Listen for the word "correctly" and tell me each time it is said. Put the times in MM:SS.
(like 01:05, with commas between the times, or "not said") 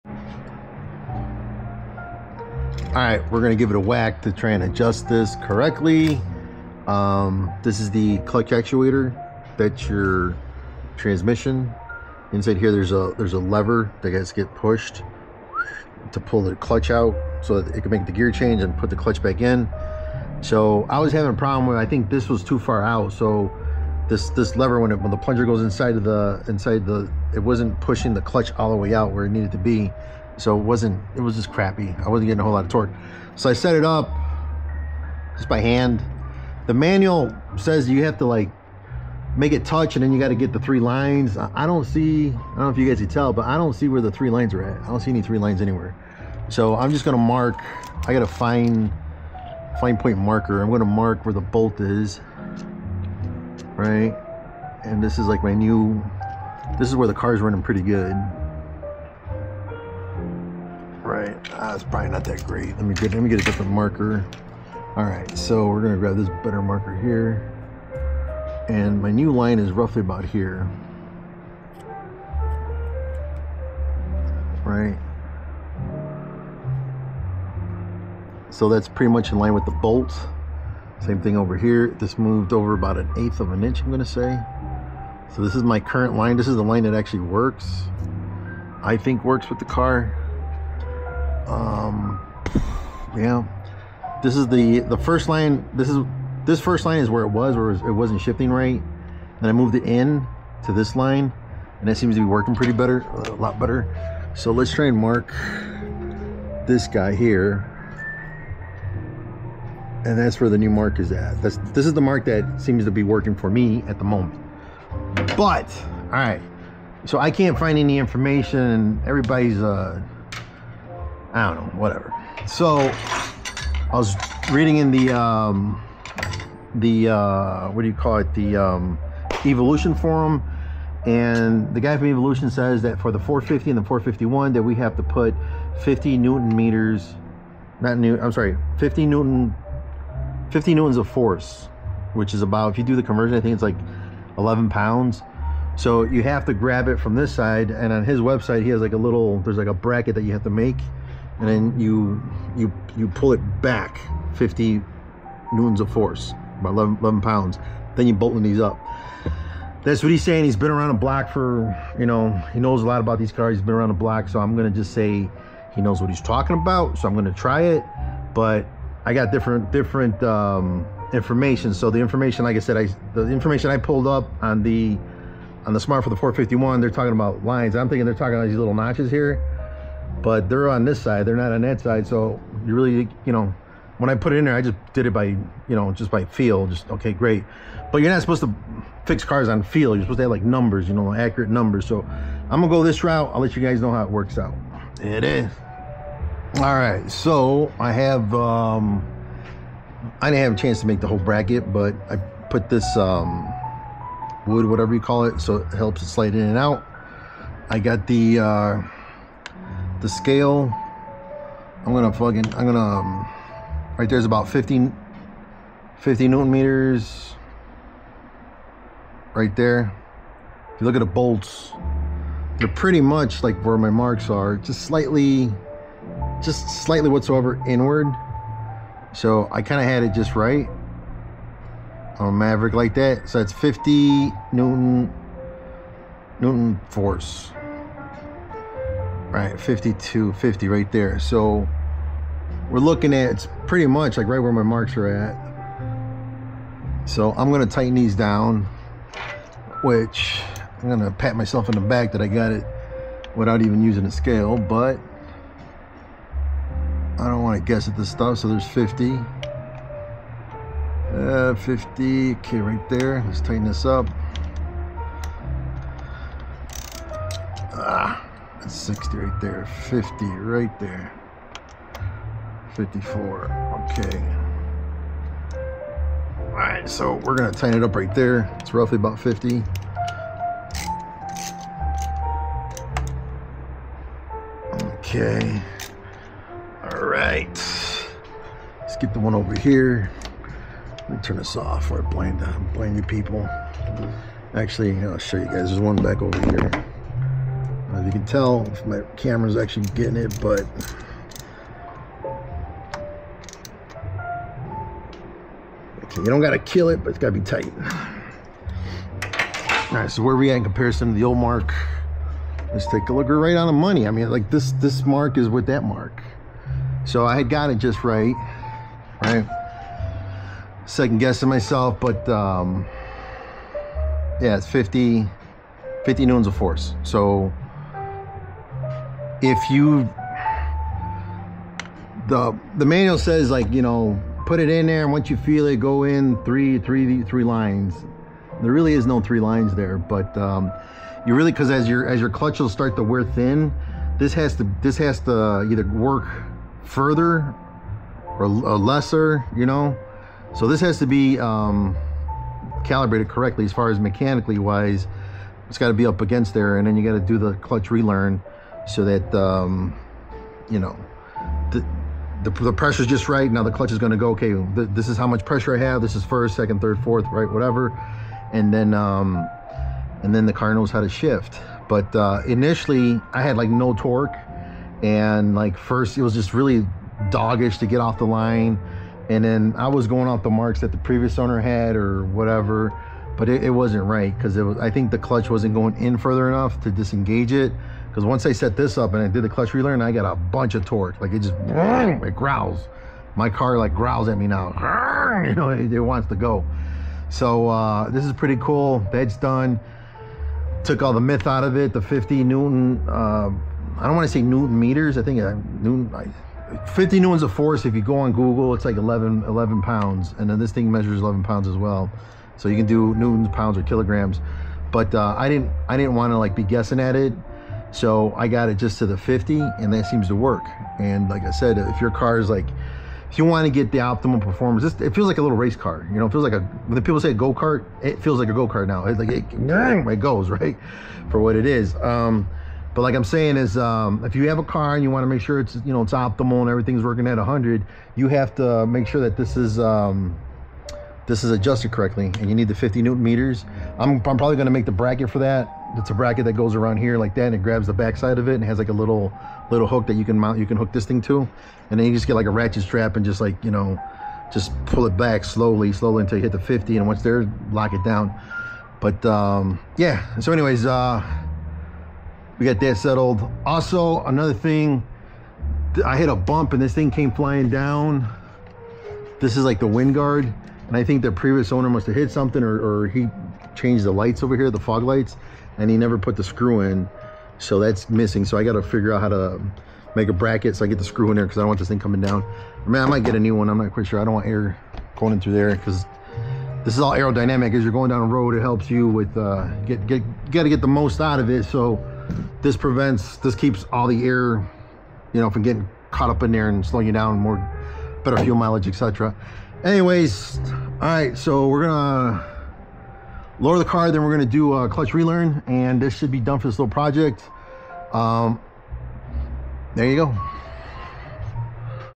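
00:05, 05:53, 07:21.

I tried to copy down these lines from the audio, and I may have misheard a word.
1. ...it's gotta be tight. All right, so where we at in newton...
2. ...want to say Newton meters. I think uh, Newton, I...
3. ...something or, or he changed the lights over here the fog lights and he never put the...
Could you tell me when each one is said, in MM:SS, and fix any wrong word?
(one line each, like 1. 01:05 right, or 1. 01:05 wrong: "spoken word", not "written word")
1. 05:07 wrong: "comparison", not "newton"
2. 06:44 right
3. 07:52 right.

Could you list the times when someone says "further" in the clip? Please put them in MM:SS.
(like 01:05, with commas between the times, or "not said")
05:46, 06:26.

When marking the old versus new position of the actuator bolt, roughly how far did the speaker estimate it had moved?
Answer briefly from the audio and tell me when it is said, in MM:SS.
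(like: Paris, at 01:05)
an eighth of an inch, at 01:22.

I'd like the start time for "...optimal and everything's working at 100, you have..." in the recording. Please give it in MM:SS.
07:16.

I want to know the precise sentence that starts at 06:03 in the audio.
Now the clutch is going to go.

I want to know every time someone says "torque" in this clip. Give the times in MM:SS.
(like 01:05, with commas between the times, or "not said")
00:32, 06:13, 06:30.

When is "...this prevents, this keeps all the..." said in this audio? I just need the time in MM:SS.
08:12.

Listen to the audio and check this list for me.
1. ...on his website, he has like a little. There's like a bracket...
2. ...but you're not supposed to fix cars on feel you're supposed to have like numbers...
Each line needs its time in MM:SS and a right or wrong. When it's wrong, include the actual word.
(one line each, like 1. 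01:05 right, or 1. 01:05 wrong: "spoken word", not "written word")
1. 02:27 right
2. 03:07 right.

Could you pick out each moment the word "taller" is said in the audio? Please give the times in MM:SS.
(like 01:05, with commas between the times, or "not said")
not said.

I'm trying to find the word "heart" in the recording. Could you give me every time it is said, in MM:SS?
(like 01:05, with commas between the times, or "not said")
not said.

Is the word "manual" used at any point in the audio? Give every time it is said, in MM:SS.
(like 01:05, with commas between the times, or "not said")
00:36, 05:32.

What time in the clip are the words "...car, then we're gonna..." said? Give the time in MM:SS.
08:23.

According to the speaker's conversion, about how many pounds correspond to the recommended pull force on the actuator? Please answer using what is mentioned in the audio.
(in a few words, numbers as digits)
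11 pounds.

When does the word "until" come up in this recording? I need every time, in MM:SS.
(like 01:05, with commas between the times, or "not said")
07:36.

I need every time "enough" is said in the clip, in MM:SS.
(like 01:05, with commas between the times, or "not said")
06:26.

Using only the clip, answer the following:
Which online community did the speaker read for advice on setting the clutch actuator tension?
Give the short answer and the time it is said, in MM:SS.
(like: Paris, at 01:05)
Evilution Forum, at 02:09.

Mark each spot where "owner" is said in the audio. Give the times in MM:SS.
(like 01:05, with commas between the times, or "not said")
06:21, 07:51.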